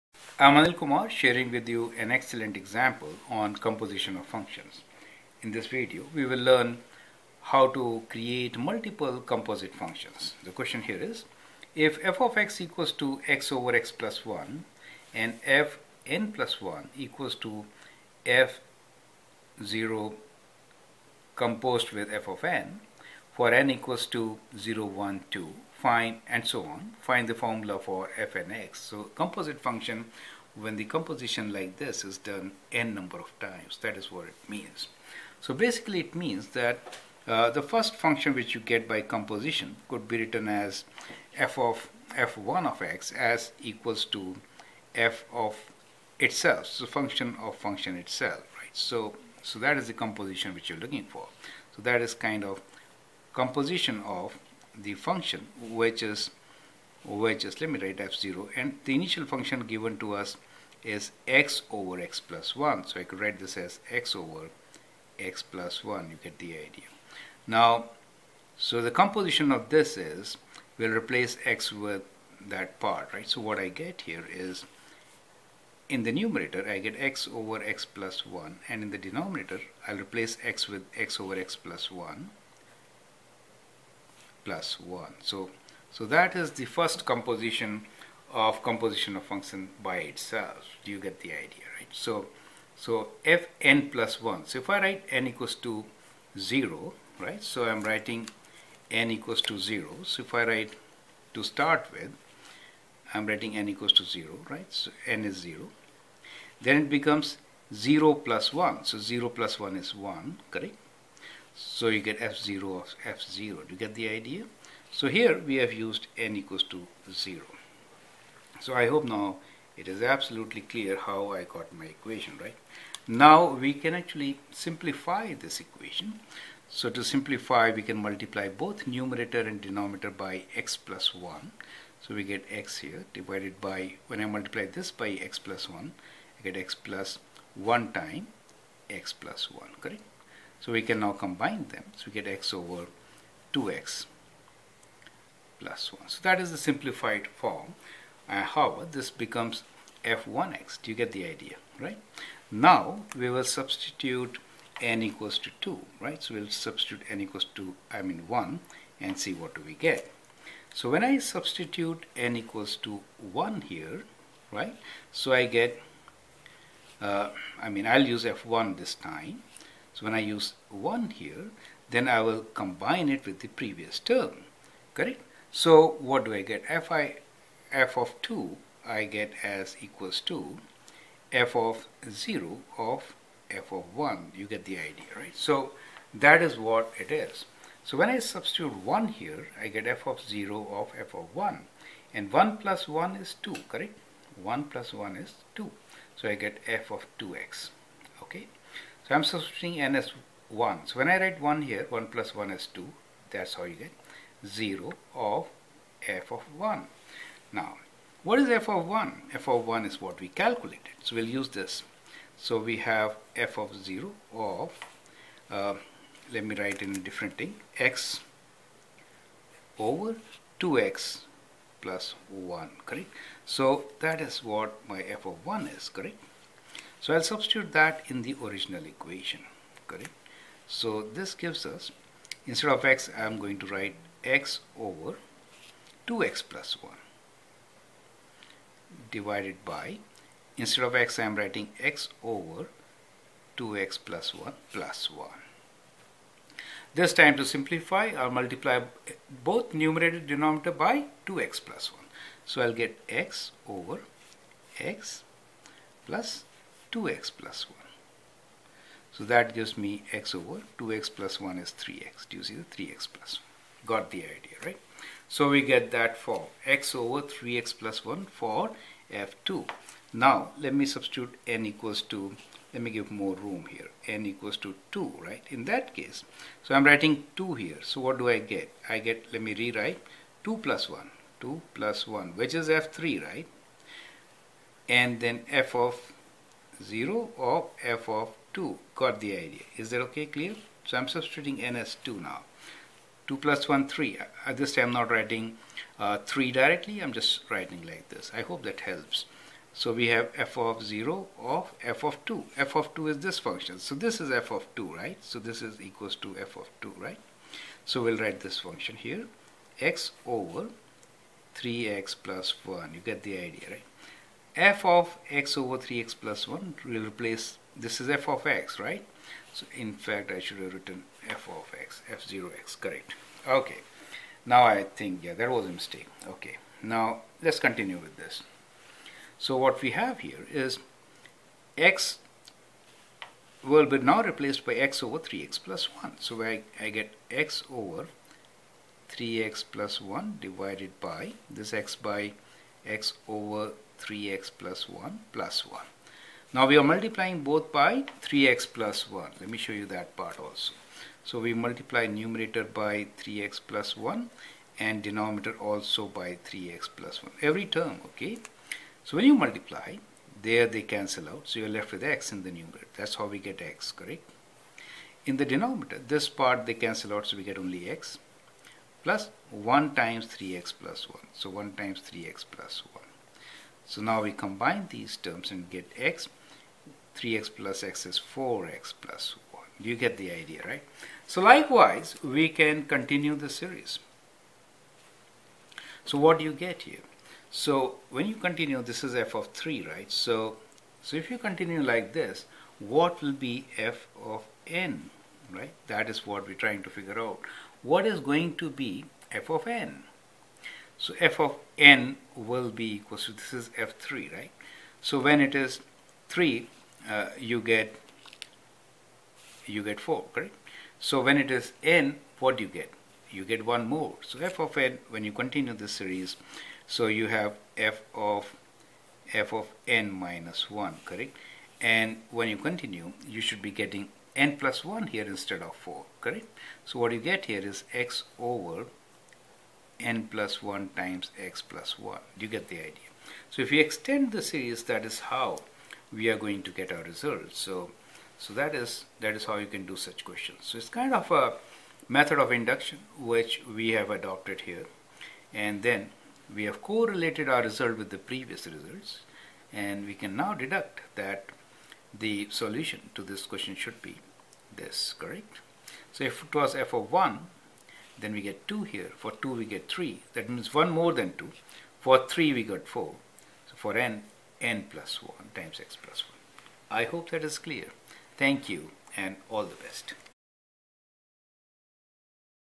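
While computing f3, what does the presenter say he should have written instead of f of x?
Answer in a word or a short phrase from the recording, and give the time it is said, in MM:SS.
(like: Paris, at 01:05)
f0x, at 05:22.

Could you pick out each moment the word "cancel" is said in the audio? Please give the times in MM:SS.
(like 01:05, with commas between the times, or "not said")
06:00, 06:06.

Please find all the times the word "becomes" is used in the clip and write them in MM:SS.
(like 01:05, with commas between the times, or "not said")
01:46, 02:29.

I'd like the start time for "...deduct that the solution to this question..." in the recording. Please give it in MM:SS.
07:30.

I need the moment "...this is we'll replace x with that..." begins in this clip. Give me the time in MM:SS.
01:09.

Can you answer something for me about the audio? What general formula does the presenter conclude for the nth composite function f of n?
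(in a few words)
x/((n+1)x+1).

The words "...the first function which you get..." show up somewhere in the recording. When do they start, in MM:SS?
00:37.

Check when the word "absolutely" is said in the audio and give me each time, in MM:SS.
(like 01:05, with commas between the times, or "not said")
02:00.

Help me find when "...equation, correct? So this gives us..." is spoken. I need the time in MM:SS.
03:48.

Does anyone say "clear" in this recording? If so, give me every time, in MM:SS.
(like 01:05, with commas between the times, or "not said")
02:00, 04:50, 07:47.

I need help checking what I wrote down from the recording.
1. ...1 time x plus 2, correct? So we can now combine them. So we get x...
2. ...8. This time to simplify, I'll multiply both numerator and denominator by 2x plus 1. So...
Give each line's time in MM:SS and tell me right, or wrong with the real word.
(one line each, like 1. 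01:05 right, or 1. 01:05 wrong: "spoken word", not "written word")
1. 02:17 wrong: "1", not "2"
2. 04:05 wrong: "1", not "8".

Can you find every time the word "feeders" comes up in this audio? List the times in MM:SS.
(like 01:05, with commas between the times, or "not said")
not said.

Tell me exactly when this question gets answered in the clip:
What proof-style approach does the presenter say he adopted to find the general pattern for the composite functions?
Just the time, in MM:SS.
07:22.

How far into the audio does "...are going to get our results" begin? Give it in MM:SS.
07:16.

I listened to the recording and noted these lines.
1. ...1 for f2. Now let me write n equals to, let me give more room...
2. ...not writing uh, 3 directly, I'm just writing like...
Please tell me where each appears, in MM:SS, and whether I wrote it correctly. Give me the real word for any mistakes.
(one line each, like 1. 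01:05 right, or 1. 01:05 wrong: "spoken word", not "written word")
1. 04:28 wrong: "substitute", not "write"
2. 04:54 right.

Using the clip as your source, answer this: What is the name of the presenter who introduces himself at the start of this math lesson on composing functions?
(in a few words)
Anil Kumar.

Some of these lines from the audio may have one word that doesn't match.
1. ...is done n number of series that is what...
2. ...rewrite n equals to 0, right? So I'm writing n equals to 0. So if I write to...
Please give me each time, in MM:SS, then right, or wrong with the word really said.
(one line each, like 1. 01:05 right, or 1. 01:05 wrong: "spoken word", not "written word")
1. 00:32 wrong: "times", not "series"
2. 01:34 wrong: "write", not "rewrite".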